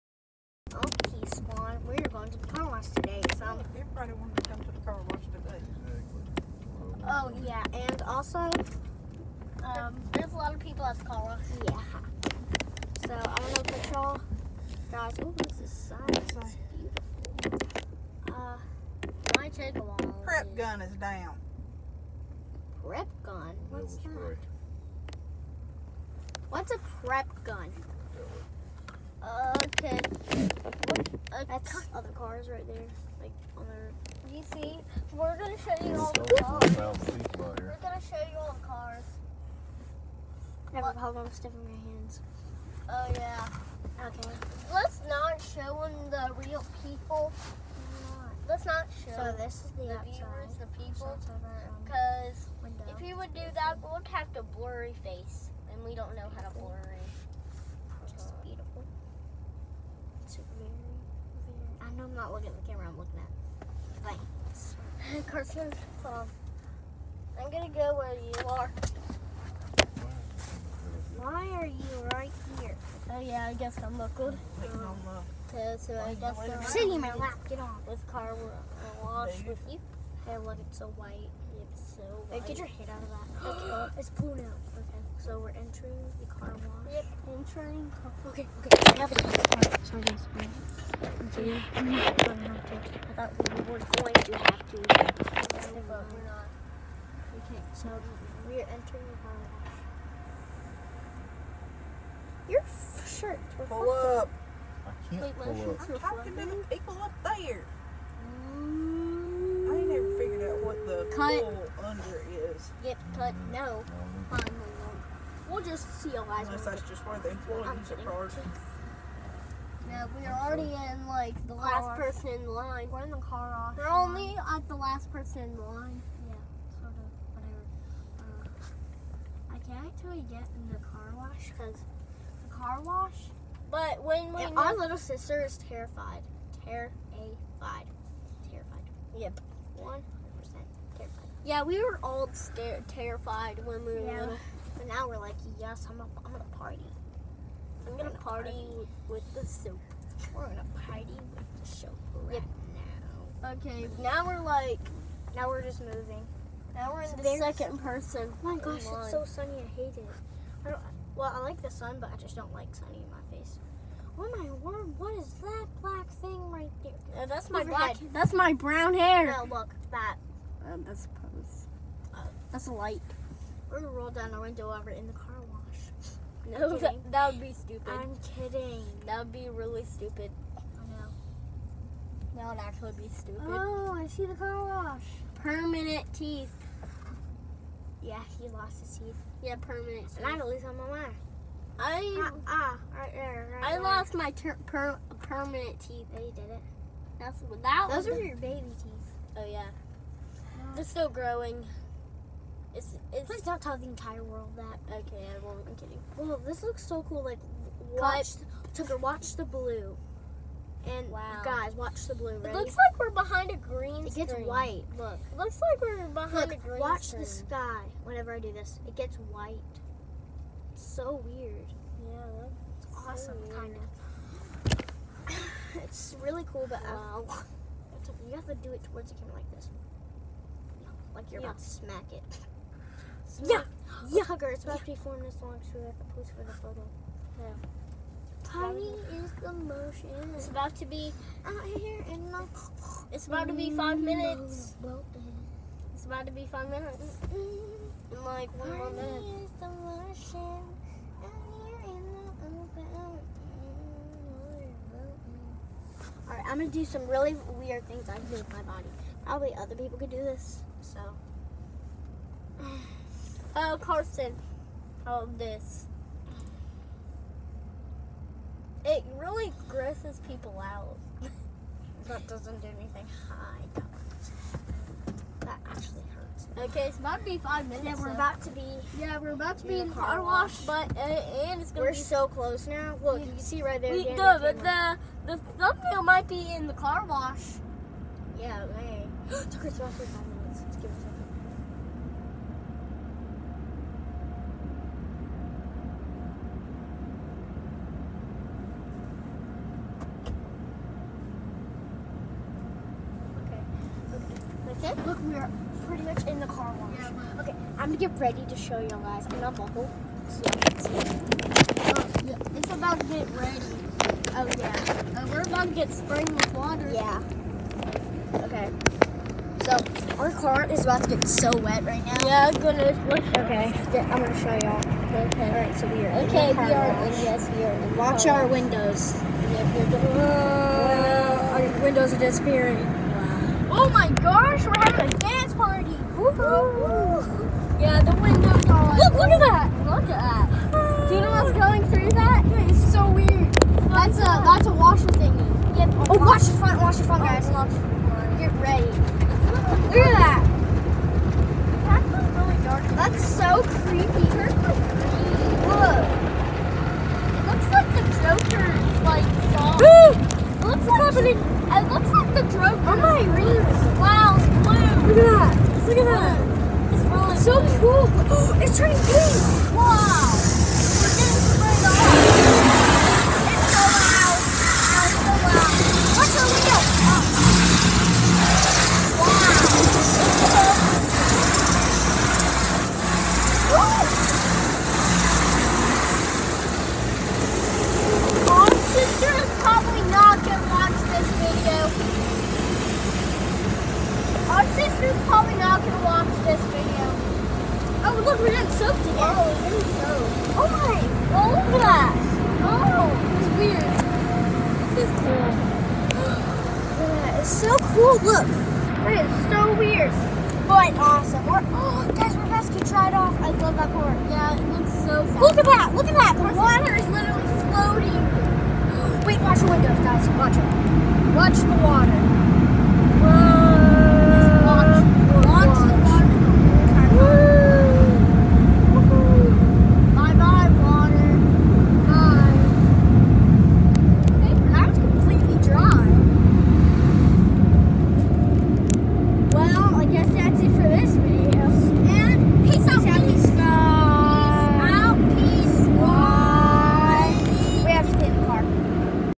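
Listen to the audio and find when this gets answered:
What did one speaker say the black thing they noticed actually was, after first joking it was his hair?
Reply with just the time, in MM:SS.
02:52.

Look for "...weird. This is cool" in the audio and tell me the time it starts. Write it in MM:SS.
06:43.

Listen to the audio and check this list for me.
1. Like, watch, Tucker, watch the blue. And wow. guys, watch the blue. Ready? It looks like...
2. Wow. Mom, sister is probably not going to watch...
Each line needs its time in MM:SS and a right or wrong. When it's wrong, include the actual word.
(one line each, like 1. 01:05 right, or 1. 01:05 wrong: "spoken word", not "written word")
1. 03:27 right
2. 06:23 right.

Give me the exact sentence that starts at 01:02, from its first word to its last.
look at the camera I'm looking at.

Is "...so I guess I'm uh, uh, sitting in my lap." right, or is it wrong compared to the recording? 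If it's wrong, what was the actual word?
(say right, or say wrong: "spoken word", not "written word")
right.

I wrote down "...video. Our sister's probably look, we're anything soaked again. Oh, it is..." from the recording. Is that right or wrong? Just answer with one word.
wrong.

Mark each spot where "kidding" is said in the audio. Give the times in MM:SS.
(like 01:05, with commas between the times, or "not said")
01:57, 02:58, 03:25.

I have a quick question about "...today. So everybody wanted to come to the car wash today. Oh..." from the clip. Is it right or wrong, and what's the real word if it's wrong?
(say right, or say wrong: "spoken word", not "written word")
right.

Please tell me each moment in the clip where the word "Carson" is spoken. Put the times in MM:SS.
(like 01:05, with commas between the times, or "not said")
01:05, 04:23.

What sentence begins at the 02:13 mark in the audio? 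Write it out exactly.
But when we, yeah, our little sister is terrified.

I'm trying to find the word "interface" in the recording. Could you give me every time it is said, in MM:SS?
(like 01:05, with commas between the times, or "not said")
not said.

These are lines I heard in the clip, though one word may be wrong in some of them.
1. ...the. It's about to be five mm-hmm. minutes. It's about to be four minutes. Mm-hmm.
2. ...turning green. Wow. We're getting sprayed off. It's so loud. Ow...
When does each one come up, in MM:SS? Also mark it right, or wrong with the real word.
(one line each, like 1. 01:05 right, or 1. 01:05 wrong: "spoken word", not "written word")
1. 04:02 wrong: "five", not "four"
2. 06:08 right.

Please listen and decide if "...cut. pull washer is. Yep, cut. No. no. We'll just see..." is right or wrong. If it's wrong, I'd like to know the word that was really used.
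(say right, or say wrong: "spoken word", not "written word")
wrong: "under", not "washer".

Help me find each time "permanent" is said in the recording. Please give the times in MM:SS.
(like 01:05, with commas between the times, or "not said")
03:05, 03:09, 03:15.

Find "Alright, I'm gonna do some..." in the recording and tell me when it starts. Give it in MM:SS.
04:16.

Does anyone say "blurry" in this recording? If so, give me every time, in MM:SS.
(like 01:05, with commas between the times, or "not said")
00:54.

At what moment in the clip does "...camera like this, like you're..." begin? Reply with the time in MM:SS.
03:49.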